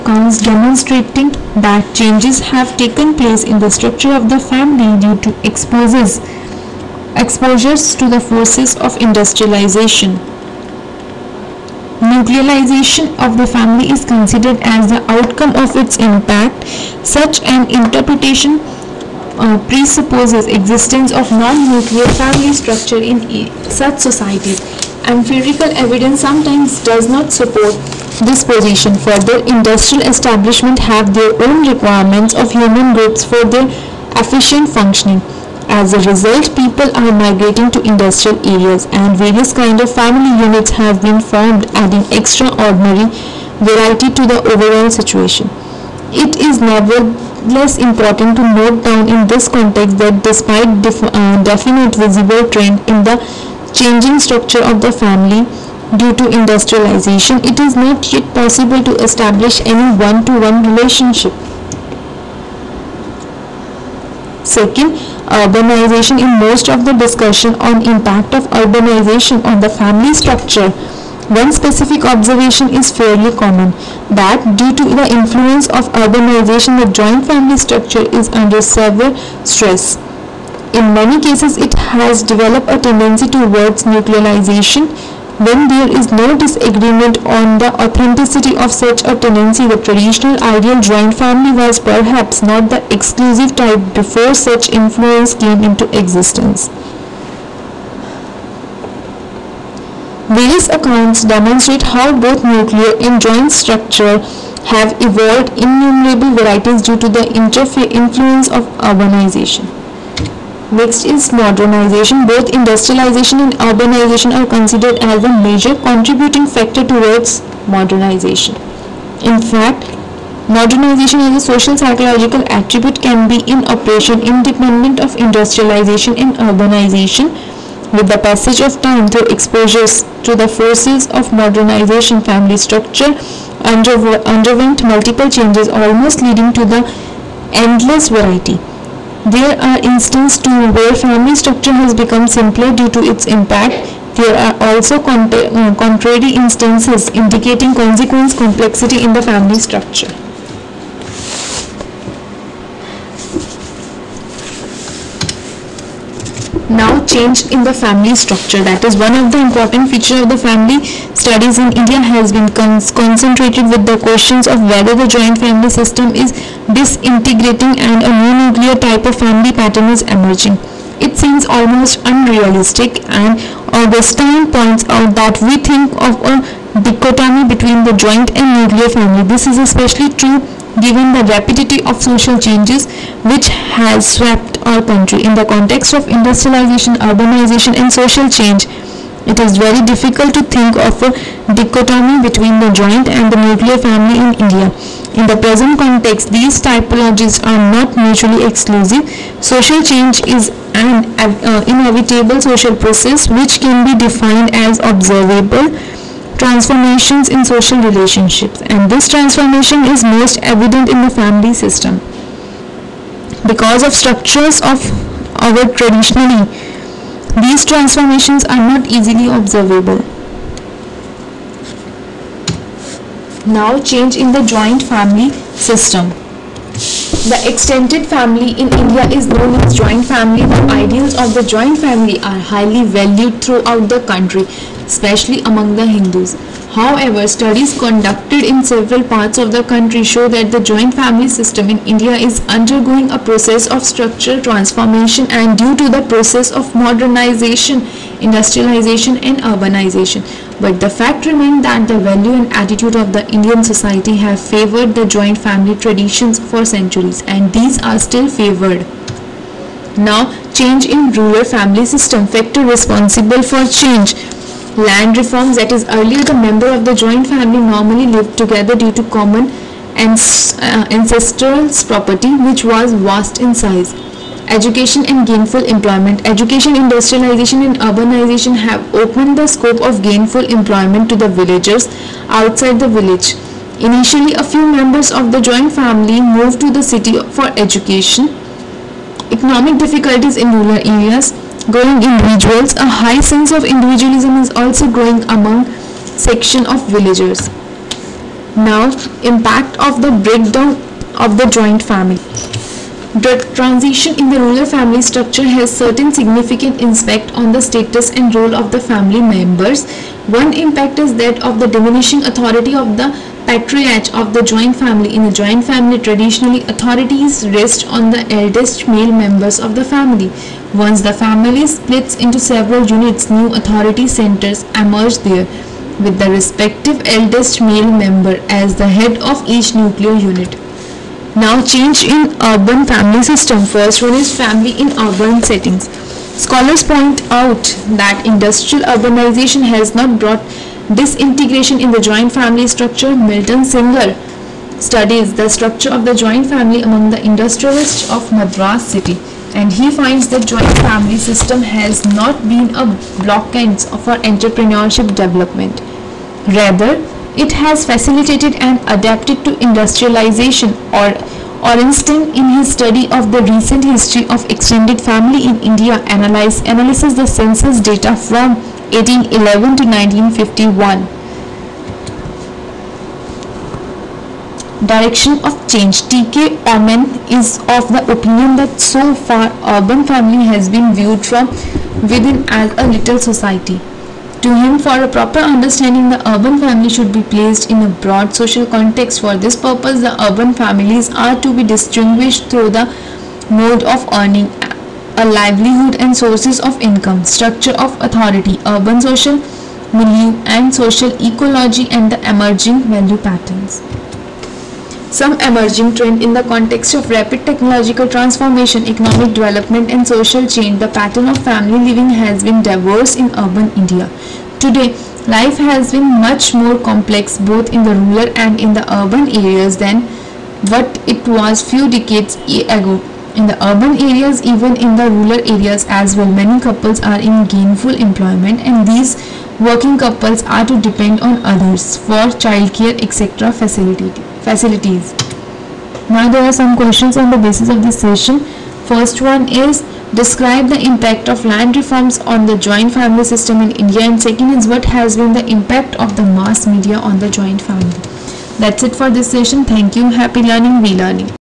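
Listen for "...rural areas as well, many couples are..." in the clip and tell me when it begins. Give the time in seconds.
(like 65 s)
425 s.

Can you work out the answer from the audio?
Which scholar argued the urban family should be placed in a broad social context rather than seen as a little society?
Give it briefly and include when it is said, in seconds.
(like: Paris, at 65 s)
T.K. Oommen, at 376 s.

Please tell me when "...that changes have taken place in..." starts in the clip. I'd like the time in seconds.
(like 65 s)
1 s.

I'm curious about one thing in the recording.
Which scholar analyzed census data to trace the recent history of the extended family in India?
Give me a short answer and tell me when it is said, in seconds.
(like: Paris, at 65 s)
Orenstein, at 361 s.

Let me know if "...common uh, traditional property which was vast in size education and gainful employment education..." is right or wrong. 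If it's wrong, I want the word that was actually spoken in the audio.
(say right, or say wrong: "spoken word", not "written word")
wrong: "ancestral", not "traditional".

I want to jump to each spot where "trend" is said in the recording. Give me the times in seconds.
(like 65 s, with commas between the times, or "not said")
52 s, 405 s.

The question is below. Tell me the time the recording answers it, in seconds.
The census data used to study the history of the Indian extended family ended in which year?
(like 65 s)
369 s.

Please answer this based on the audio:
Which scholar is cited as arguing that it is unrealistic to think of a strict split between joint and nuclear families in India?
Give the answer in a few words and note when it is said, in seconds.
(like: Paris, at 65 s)
Augustine, at 173 s.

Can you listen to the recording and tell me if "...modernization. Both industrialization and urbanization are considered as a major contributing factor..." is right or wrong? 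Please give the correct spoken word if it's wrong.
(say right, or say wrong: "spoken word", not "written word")
right.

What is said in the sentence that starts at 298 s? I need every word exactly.
Now, impact of the breakdown of the joint family.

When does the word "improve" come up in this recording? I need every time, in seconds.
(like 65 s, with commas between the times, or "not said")
not said.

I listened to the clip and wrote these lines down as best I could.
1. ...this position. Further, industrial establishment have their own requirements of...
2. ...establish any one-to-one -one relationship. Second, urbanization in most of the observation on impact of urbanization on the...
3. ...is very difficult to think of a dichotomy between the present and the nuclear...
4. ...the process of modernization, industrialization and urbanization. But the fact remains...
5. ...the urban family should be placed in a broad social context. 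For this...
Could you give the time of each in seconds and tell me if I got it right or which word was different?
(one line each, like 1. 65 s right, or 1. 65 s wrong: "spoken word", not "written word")
1. 28 s right
2. 59 s wrong: "discussion", not "observation"
3. 189 s wrong: "joint", not "present"
4. 245 s right
5. 386 s right.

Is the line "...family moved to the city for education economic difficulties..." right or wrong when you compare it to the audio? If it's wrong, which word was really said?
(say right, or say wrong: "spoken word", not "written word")
right.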